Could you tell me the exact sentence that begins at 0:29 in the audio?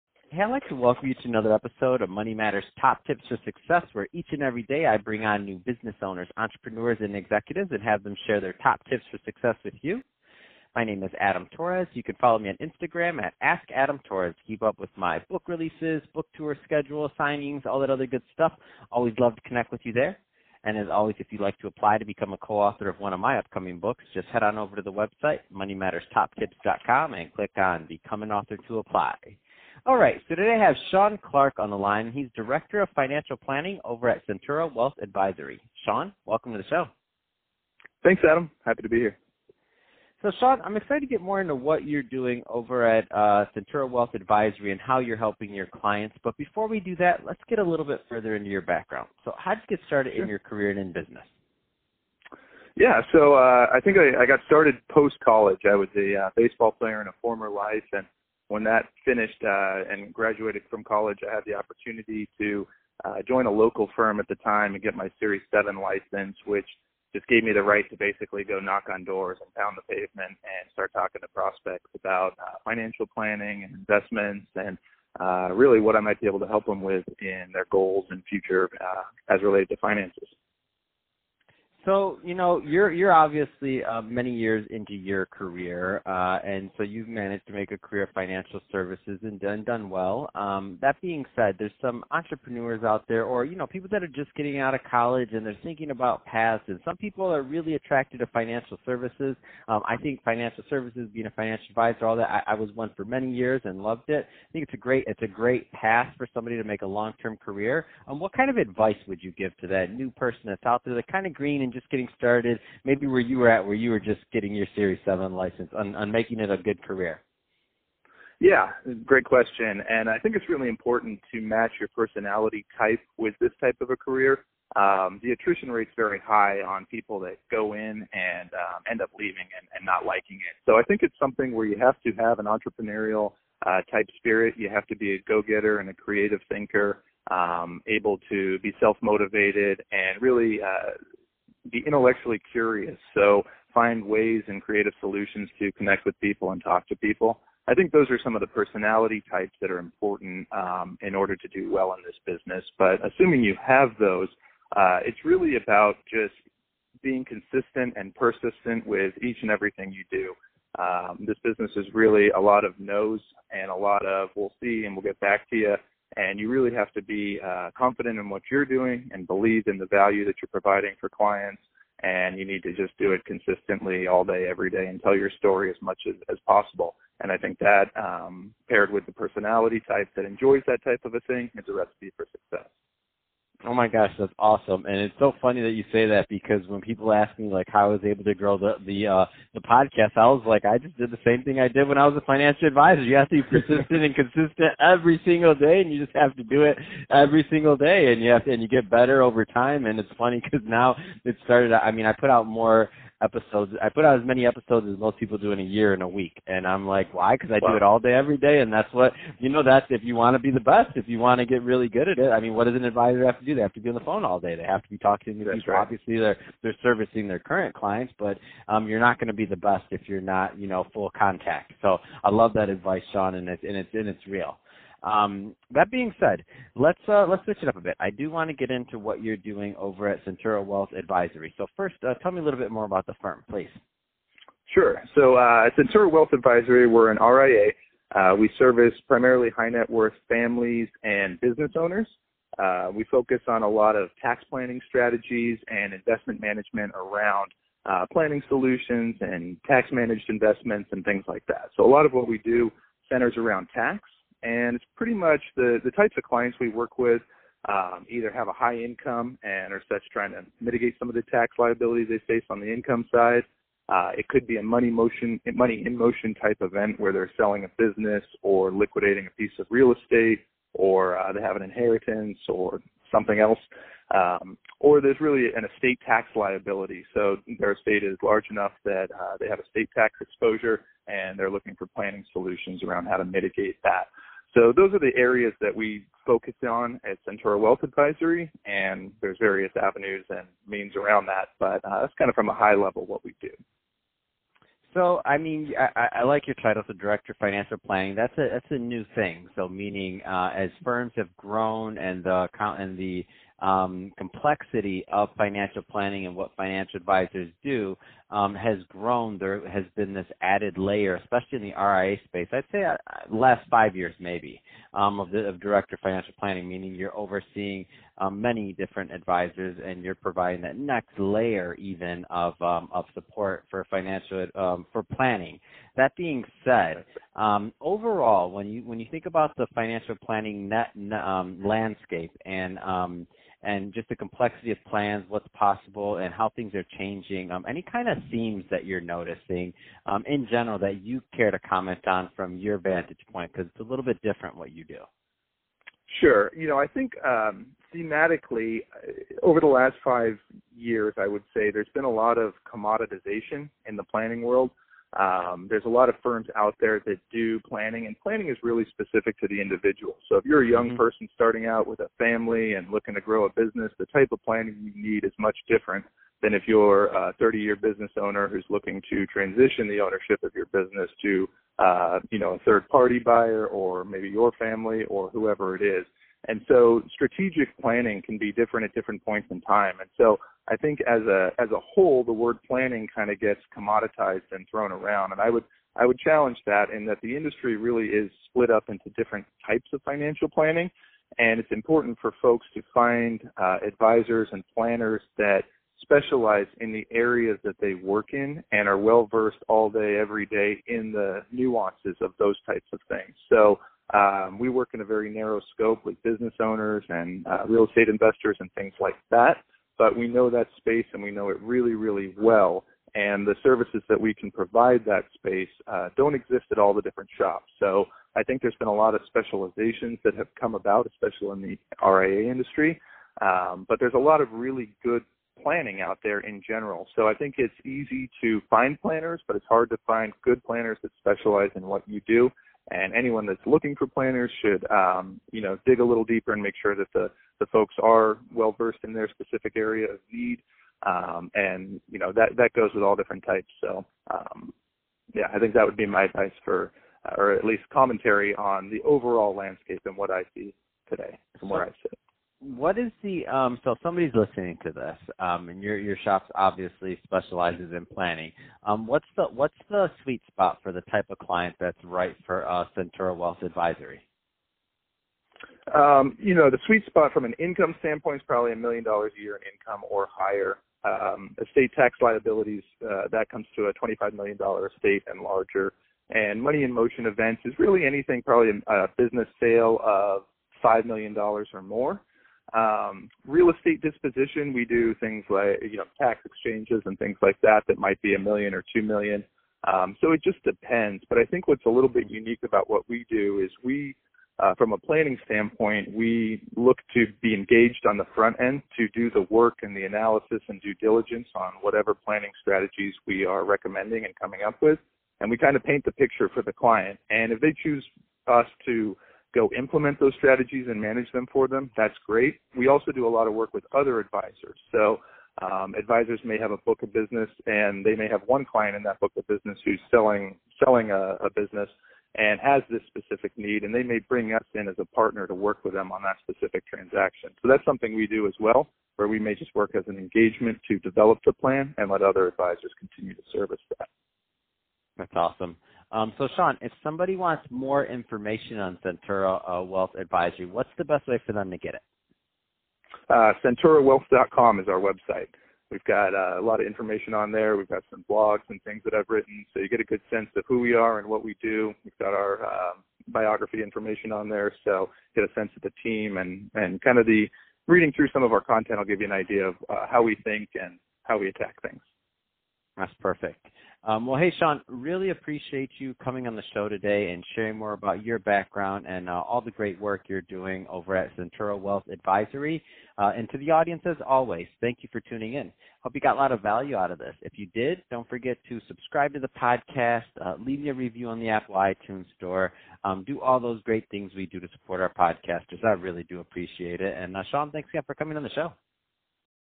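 All right, so today I have Sean Clark on the line.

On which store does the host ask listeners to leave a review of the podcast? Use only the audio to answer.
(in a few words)
Apple iTunes Store.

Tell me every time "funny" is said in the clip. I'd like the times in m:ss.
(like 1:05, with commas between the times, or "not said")
3:05, 3:20.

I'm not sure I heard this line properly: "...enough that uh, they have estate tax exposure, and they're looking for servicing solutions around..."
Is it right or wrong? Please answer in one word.
wrong.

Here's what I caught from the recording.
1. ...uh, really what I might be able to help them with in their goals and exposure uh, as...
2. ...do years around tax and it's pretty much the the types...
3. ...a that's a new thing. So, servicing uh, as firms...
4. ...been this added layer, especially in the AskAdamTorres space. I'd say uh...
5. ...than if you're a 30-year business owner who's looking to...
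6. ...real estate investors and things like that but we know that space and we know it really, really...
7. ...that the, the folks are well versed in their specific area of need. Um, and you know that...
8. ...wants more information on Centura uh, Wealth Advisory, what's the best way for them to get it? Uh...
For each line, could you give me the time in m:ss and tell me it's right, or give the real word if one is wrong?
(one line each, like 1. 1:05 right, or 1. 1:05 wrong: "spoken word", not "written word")
1. 1:15 wrong: "future", not "exposure"
2. 4:12 wrong: "centers", not "years"
3. 4:58 wrong: "meaning", not "servicing"
4. 5:09 wrong: "RIA", not "AskAdamTorres"
5. 6:06 right
6. 6:47 right
7. 7:16 right
8. 8:57 right.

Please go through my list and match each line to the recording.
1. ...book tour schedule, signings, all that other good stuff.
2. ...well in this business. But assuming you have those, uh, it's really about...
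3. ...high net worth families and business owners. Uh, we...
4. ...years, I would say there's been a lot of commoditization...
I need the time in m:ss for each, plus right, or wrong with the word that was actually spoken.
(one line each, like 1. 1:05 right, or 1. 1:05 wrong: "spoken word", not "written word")
1. 0:16 right
2. 2:31 right
3. 3:59 right
4. 5:50 right.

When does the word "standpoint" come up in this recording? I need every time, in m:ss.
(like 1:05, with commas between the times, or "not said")
7:47, 8:15.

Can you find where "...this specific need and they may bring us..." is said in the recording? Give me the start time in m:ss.
8:42.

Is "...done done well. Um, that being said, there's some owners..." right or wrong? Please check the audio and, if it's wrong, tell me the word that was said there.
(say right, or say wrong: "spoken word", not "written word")
wrong: "entrepreneurs", not "owners".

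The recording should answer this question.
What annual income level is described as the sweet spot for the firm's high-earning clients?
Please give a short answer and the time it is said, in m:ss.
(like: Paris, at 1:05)
$1 million, at 7:48.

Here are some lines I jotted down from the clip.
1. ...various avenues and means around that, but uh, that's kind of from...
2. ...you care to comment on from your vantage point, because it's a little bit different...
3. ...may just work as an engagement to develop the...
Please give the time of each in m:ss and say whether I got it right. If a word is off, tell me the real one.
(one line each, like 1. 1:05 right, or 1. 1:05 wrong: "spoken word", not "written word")
1. 4:49 right
2. 5:41 right
3. 8:49 right.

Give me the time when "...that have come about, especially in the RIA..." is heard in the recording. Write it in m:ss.
7:00.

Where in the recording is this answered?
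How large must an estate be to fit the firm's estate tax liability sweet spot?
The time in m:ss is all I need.
7:53.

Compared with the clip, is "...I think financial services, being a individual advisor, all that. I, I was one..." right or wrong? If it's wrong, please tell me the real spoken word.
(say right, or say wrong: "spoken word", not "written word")
wrong: "financial", not "individual".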